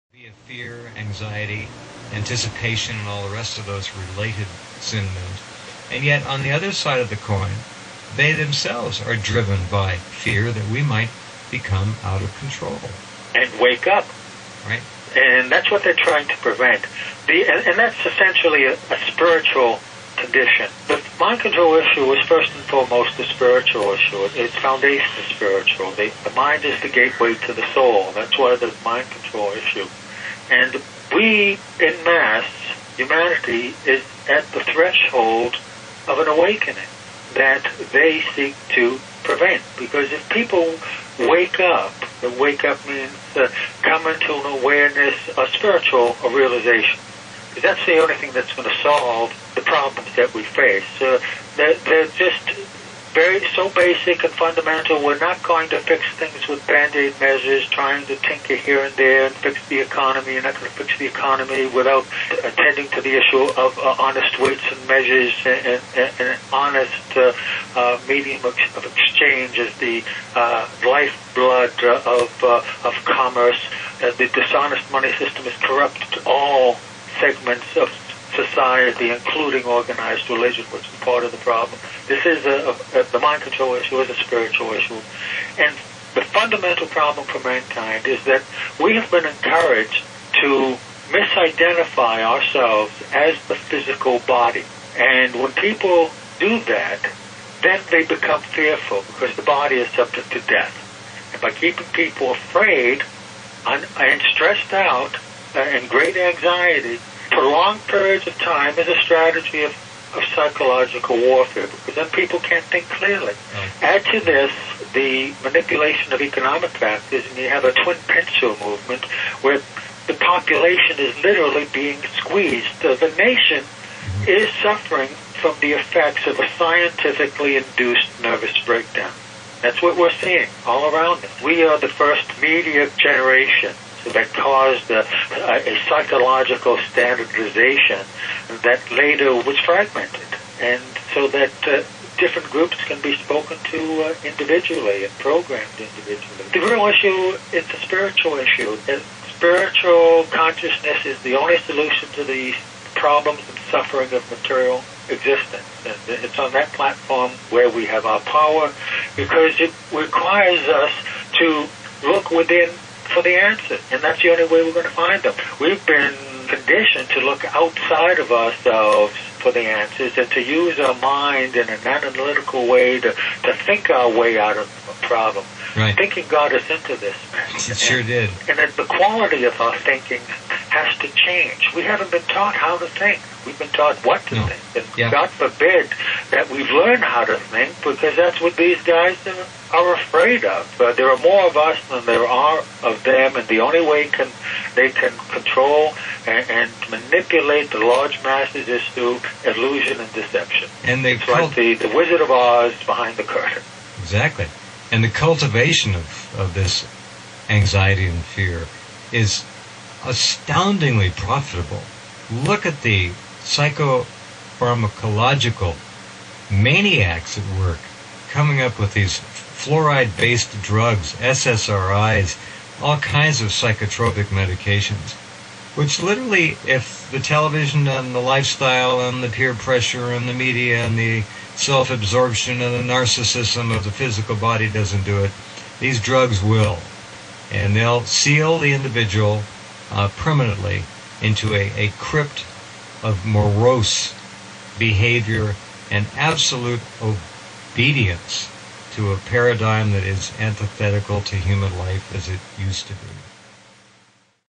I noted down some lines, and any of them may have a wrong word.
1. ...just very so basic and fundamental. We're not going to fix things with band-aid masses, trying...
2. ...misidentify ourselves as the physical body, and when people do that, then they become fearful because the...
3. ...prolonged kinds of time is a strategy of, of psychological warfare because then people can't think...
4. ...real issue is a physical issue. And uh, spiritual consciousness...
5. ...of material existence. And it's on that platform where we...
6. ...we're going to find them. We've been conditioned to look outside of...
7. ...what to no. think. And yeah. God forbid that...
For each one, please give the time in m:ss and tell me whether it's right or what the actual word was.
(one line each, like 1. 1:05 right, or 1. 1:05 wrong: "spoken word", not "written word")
1. 0:52 wrong: "measures", not "masses"
2. 1:31 right
3. 1:47 wrong: "periods", not "kinds"
4. 2:26 wrong: "spiritual", not "physical"
5. 2:34 right
6. 2:44 right
7. 3:04 right.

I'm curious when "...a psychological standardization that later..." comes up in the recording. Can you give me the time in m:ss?
2:15.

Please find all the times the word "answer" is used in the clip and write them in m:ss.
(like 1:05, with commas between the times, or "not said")
2:43, 2:49.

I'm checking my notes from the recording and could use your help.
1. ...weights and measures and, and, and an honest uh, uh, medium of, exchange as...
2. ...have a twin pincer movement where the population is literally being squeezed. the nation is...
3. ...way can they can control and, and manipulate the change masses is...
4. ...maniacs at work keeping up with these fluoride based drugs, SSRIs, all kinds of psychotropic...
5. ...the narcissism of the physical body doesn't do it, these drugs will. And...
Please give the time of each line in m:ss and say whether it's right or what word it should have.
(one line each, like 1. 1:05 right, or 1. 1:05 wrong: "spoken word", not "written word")
1. 1:04 right
2. 1:57 right
3. 3:13 wrong: "large", not "change"
4. 3:36 wrong: "coming", not "keeping"
5. 3:52 right.